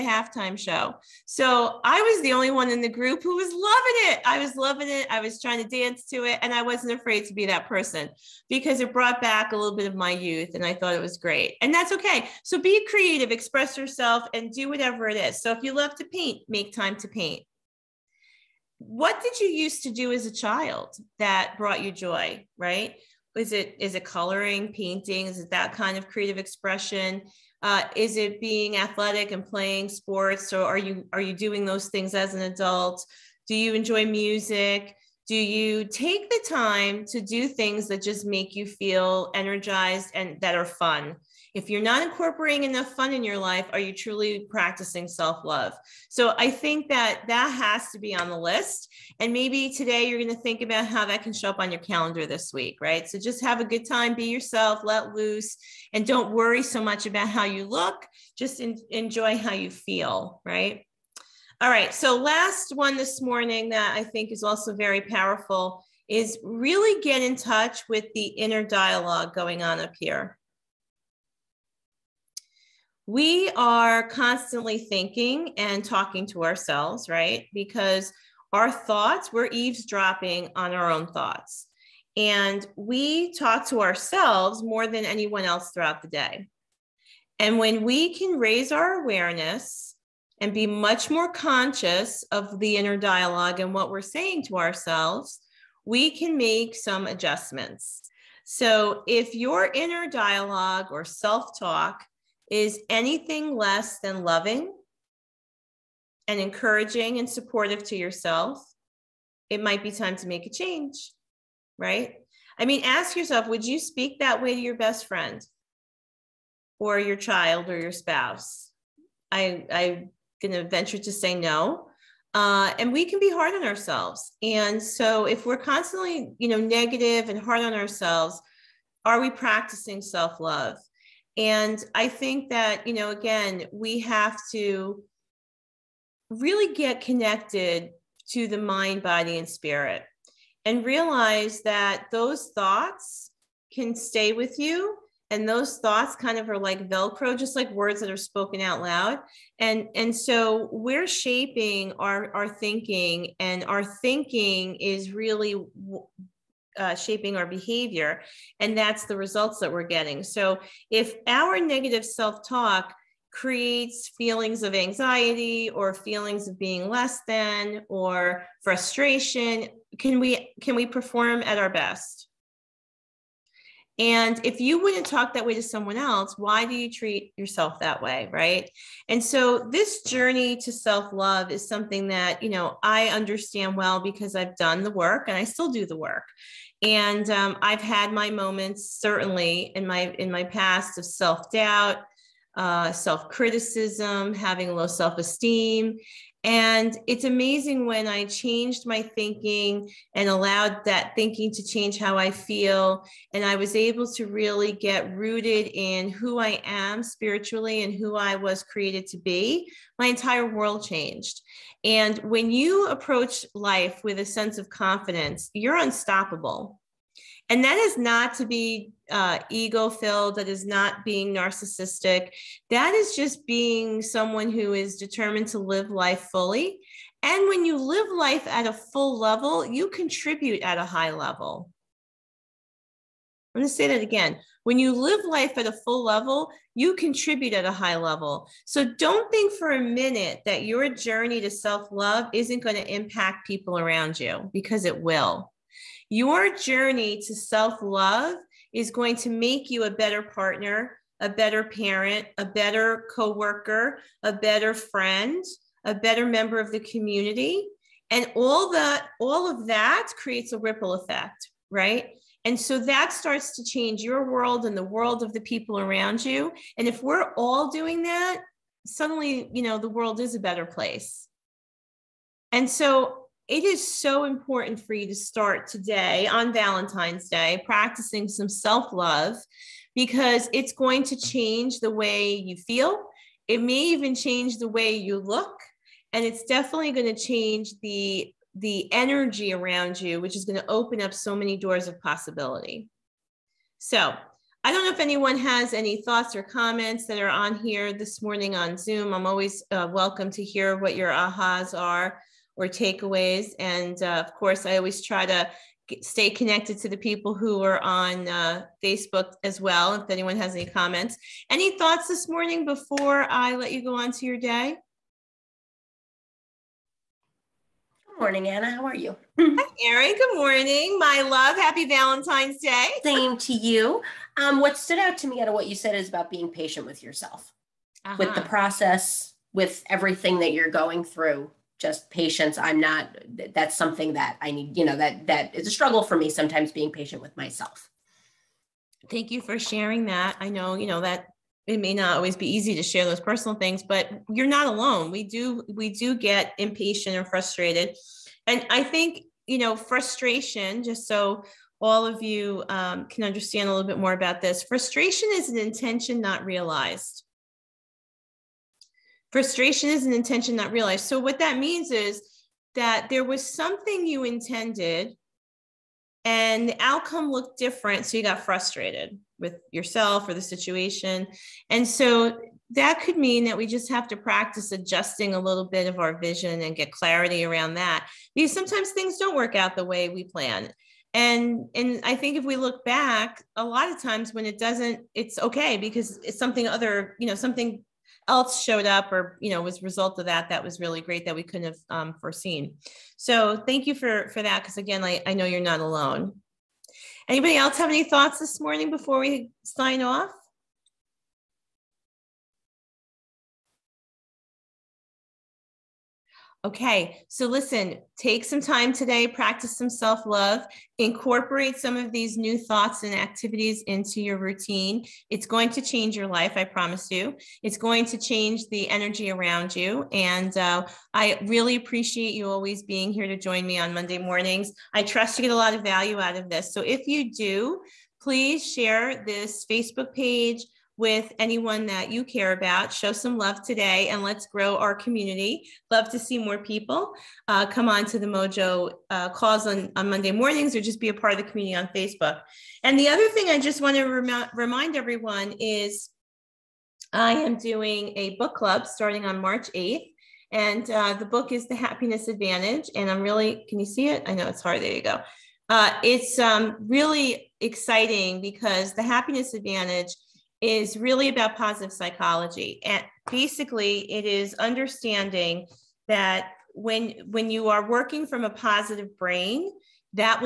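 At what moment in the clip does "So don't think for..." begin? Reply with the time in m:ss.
3:58.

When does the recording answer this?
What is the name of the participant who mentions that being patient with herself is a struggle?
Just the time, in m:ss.
5:18.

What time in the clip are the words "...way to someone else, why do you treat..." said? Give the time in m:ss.
2:55.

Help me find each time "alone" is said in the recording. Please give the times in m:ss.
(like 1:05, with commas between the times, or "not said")
5:44, 6:35.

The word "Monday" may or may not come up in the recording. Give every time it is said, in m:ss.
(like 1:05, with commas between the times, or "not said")
7:03, 7:20.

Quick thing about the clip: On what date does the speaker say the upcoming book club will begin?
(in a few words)
March 8th.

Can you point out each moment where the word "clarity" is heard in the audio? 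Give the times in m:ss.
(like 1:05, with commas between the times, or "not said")
6:16.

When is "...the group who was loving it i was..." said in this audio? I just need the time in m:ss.
0:02.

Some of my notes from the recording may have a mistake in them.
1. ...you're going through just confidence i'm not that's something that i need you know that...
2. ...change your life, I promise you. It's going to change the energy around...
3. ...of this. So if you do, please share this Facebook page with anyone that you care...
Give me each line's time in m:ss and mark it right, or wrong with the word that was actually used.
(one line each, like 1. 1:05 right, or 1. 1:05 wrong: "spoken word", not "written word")
1. 5:30 wrong: "patience", not "confidence"
2. 6:55 right
3. 7:06 right.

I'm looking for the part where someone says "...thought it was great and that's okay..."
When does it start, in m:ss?
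0:10.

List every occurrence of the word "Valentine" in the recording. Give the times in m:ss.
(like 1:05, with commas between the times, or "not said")
4:36, 5:21.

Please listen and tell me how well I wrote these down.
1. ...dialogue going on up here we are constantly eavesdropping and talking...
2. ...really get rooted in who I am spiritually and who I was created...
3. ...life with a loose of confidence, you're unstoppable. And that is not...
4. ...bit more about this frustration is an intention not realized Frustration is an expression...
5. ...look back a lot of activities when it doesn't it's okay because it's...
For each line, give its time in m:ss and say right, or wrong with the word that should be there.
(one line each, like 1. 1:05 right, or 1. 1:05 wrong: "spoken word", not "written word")
1. 1:08 wrong: "thinking", not "eavesdropping"
2. 3:24 right
3. 3:33 wrong: "sense", not "loose"
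4. 5:53 wrong: "intention", not "expression"
5. 6:22 wrong: "times", not "activities".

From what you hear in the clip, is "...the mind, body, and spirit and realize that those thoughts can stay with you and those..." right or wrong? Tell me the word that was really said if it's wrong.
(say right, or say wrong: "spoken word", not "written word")
right.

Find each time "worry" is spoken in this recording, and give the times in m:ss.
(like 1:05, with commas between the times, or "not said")
0:56.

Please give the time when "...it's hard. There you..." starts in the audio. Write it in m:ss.
7:34.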